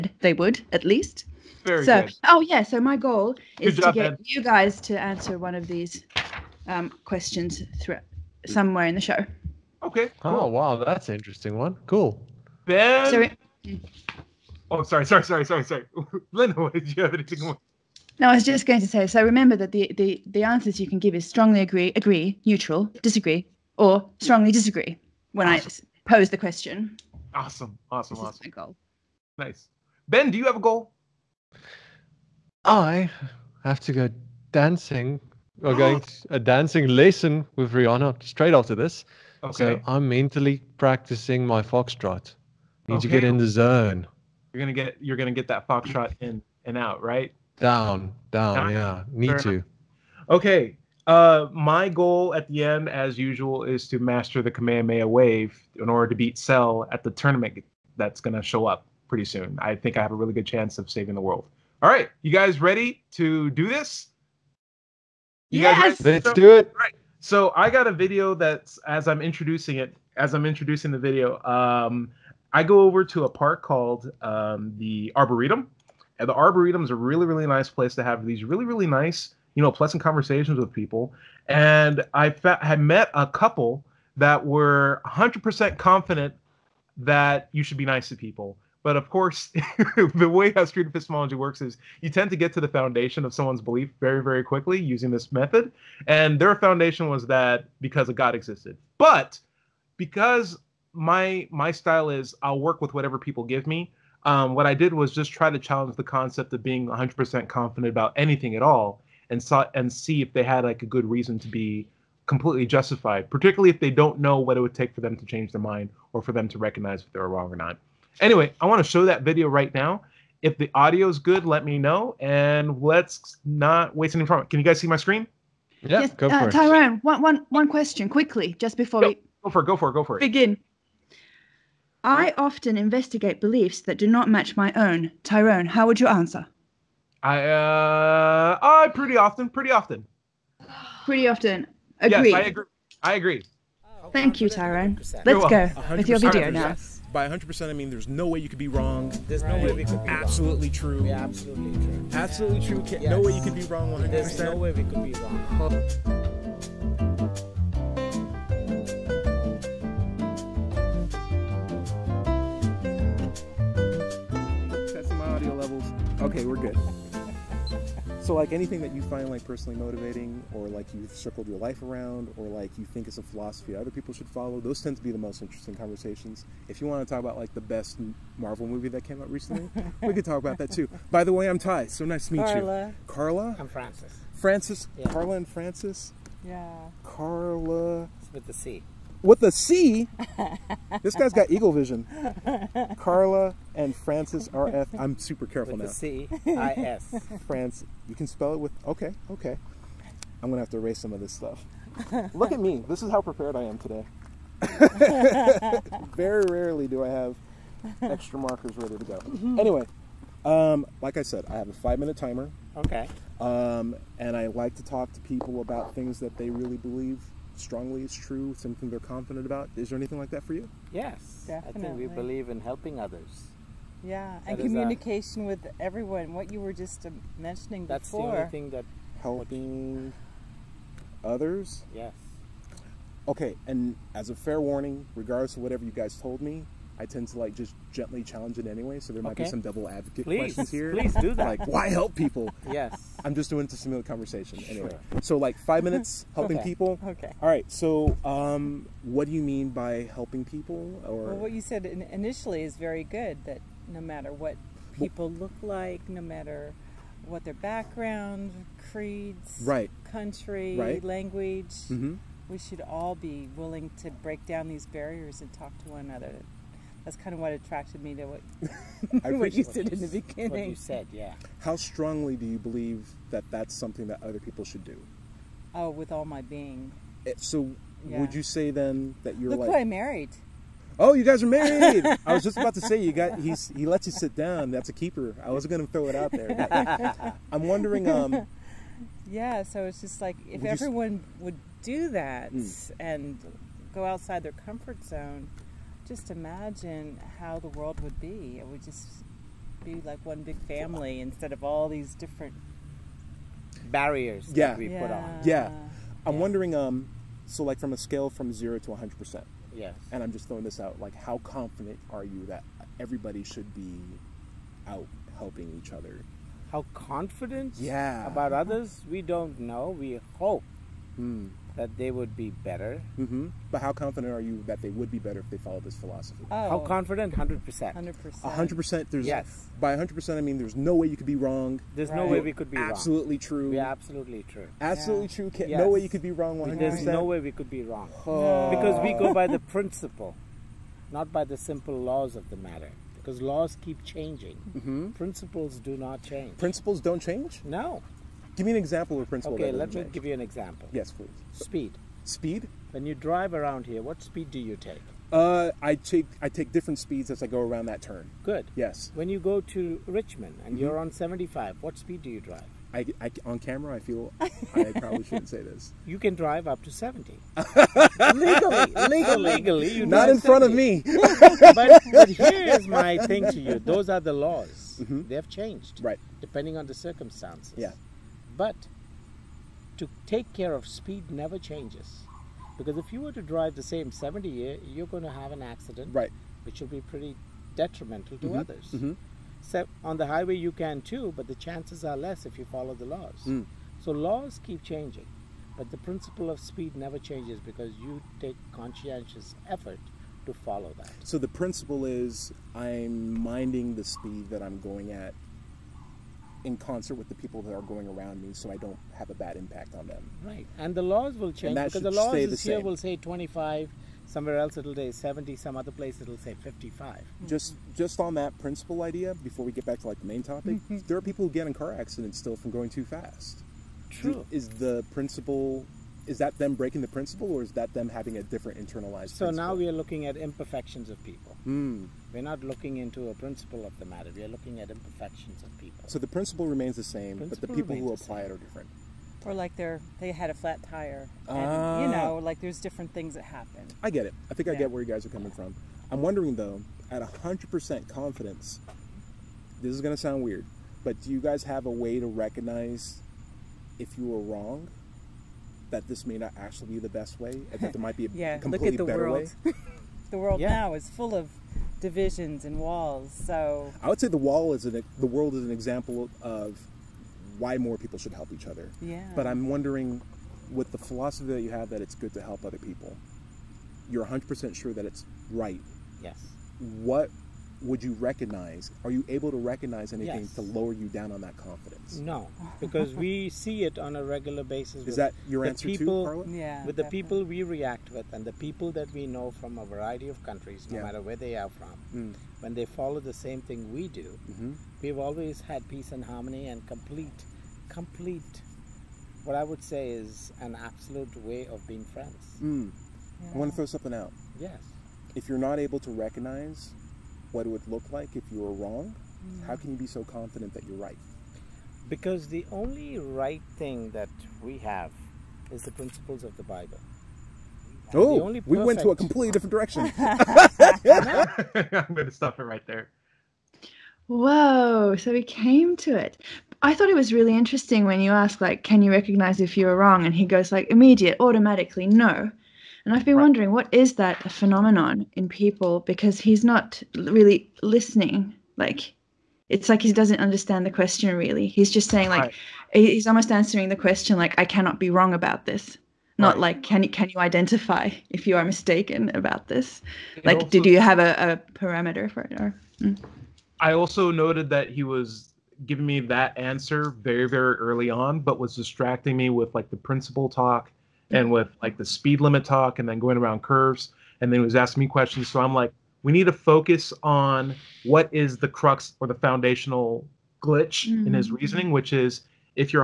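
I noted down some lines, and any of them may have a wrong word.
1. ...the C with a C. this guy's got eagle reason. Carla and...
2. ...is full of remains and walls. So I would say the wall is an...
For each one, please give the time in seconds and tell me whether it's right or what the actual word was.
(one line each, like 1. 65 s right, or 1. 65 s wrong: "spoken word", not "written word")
1. 188 s wrong: "vision", not "reason"
2. 460 s wrong: "divisions", not "remains".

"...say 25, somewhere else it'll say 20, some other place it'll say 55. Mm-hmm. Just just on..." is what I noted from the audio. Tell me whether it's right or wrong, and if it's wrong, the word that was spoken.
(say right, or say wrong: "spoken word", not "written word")
wrong: "70", not "20".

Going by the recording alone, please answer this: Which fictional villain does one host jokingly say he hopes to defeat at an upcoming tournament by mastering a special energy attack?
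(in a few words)
Cell.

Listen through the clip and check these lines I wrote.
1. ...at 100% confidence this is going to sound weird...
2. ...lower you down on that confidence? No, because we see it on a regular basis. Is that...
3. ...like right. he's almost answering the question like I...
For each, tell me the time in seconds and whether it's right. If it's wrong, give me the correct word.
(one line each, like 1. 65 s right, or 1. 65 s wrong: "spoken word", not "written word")
1. 447 s right
2. 480 s right
3. 542 s right.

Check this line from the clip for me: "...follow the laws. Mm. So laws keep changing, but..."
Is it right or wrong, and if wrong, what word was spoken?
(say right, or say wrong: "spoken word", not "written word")
right.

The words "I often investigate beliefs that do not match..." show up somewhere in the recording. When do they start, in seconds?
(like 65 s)
132 s.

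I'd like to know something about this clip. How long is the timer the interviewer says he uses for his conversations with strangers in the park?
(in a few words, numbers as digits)
5 minutes.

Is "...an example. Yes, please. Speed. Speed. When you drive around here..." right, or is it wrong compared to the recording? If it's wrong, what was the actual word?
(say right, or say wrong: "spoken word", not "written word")
right.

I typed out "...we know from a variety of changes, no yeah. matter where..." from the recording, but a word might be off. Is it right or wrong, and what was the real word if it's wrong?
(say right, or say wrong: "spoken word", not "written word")
wrong: "countries", not "changes".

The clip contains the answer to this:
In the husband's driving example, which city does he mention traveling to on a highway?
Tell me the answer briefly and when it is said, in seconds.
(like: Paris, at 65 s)
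Richmond, at 360 s.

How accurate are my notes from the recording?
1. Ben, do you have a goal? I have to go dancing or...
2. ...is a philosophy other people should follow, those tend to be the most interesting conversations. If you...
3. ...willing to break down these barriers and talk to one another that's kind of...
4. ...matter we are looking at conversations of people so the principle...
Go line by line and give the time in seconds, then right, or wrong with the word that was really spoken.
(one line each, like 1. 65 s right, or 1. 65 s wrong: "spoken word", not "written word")
1. 30 s right
2. 173 s right
3. 263 s right
4. 434 s wrong: "imperfections", not "conversations".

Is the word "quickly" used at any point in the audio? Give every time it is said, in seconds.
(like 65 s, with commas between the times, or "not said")
94 s, 128 s.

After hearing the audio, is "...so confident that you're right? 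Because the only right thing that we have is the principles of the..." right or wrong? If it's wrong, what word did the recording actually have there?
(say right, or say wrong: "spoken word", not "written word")
right.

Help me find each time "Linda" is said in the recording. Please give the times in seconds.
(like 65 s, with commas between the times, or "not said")
16 s.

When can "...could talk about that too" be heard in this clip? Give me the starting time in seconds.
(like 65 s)
180 s.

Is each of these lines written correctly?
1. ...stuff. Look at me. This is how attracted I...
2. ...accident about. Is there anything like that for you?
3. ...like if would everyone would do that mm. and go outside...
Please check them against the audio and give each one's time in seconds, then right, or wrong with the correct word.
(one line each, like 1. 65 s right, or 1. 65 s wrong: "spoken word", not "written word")
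1. 201 s wrong: "prepared", not "attracted"
2. 218 s wrong: "confident", not "accident"
3. 290 s right.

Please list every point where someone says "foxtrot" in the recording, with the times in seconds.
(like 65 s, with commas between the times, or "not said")
41 s, 45 s.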